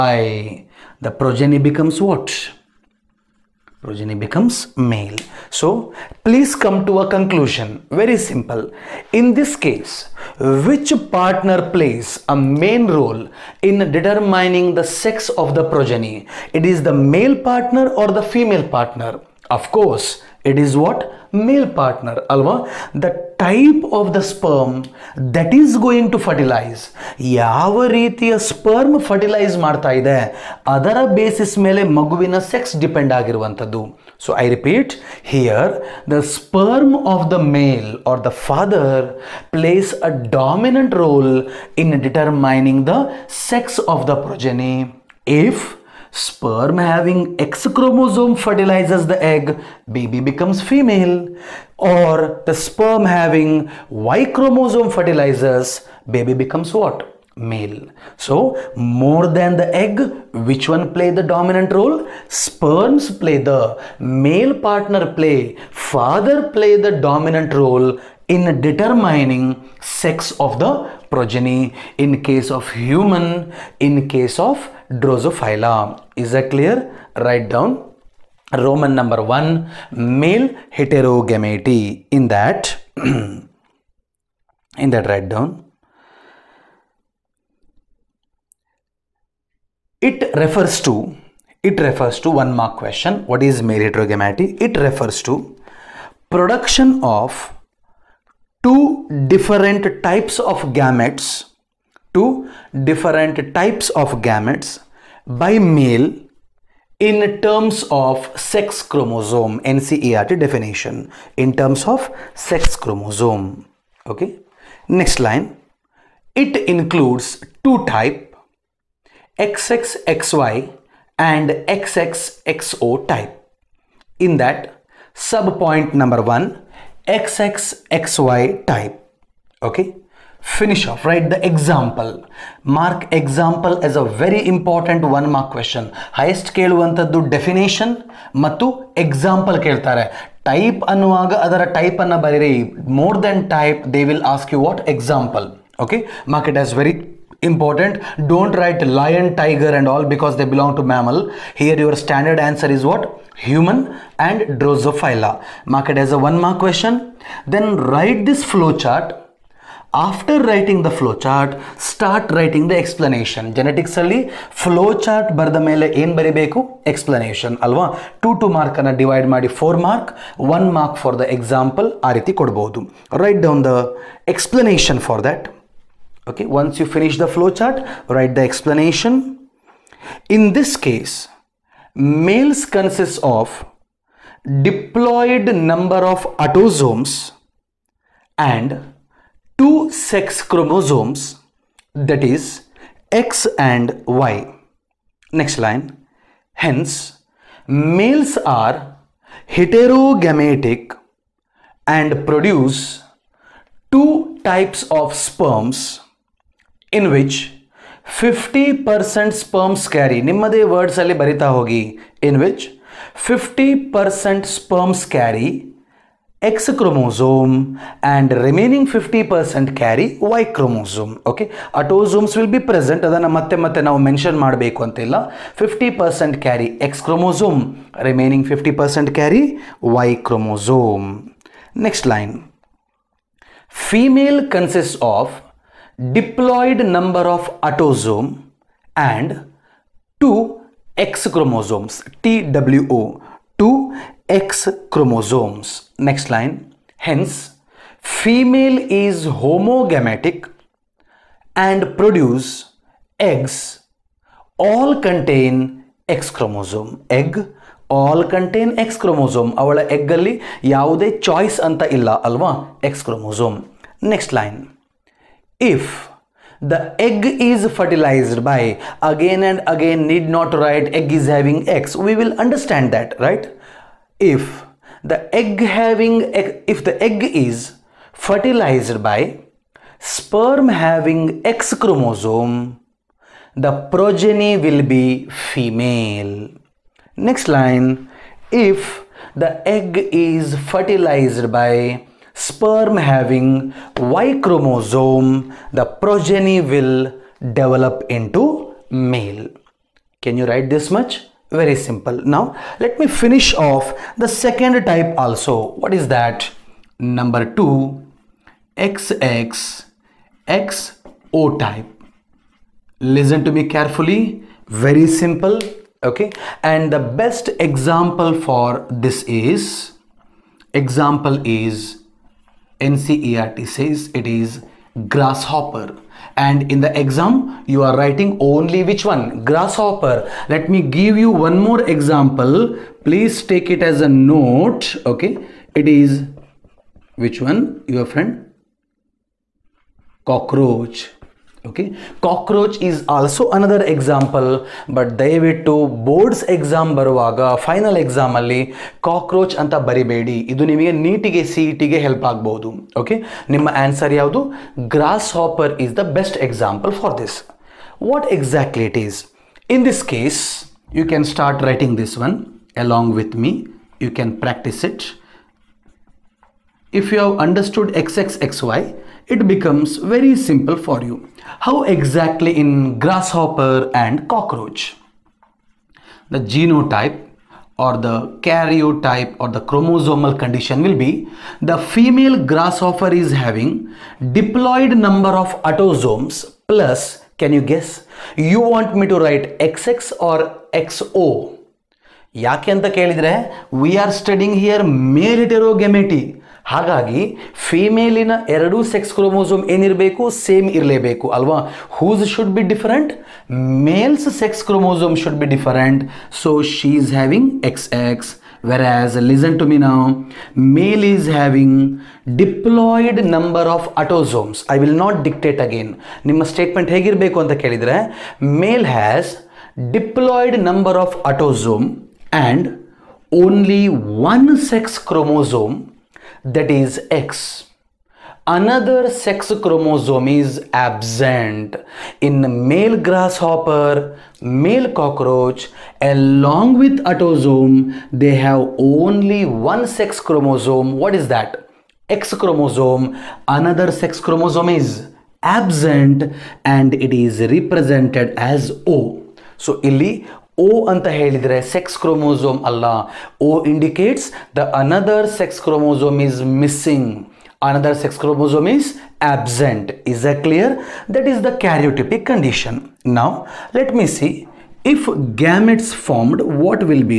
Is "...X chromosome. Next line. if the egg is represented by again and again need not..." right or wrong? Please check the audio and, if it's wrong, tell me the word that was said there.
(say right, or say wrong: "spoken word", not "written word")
wrong: "fertilized", not "represented".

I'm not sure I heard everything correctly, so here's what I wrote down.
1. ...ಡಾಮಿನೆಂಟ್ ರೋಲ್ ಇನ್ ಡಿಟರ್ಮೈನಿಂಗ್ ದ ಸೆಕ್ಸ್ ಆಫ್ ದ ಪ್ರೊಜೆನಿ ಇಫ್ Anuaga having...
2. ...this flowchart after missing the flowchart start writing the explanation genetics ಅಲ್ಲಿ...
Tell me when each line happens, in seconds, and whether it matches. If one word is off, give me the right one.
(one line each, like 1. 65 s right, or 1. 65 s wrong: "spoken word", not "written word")
1. 40 s wrong: "Sperm", not "Anuaga"
2. 158 s wrong: "writing", not "missing".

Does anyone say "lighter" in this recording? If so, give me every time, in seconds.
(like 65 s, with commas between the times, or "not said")
not said.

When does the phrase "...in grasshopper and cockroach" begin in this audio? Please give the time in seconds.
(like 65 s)
372 s.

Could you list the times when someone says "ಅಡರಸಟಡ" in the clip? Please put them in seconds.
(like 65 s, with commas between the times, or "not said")
367 s.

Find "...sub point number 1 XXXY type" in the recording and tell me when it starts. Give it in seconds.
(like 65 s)
125 s.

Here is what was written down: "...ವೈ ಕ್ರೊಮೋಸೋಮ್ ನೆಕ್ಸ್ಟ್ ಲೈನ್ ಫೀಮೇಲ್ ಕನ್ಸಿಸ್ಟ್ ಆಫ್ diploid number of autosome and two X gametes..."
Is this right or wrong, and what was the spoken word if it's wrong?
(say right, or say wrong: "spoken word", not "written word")
wrong: "chromosomes", not "gametes".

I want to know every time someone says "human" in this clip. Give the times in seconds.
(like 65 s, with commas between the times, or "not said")
72 s, 153 s.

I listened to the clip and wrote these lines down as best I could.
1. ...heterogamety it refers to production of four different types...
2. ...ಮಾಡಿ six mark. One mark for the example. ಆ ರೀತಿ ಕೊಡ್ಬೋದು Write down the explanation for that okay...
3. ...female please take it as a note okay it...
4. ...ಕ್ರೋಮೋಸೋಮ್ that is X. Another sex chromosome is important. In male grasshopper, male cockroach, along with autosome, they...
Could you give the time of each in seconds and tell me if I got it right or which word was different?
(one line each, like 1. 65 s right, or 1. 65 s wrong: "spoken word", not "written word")
1. 93 s wrong: "two", not "four"
2. 169 s wrong: "four", not "six"
3. 331 s wrong: "example", not "female"
4. 425 s wrong: "absent", not "important".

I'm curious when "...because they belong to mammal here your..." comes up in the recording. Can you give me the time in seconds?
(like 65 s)
150 s.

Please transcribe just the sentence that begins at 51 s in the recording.
Or the sperm having Y chromosome fertilizes, baby becomes what?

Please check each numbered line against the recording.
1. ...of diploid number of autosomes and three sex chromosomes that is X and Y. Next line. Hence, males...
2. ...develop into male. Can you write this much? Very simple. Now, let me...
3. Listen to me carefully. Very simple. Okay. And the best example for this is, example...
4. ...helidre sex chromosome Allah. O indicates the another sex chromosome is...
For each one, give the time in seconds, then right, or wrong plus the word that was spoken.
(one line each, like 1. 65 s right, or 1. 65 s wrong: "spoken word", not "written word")
1. 183 s wrong: "two", not "three"
2. 297 s right
3. 312 s right
4. 451 s right.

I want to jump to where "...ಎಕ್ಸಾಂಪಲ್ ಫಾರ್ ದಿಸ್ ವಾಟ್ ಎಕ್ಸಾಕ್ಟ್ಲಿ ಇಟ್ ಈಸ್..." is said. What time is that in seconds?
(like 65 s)
356 s.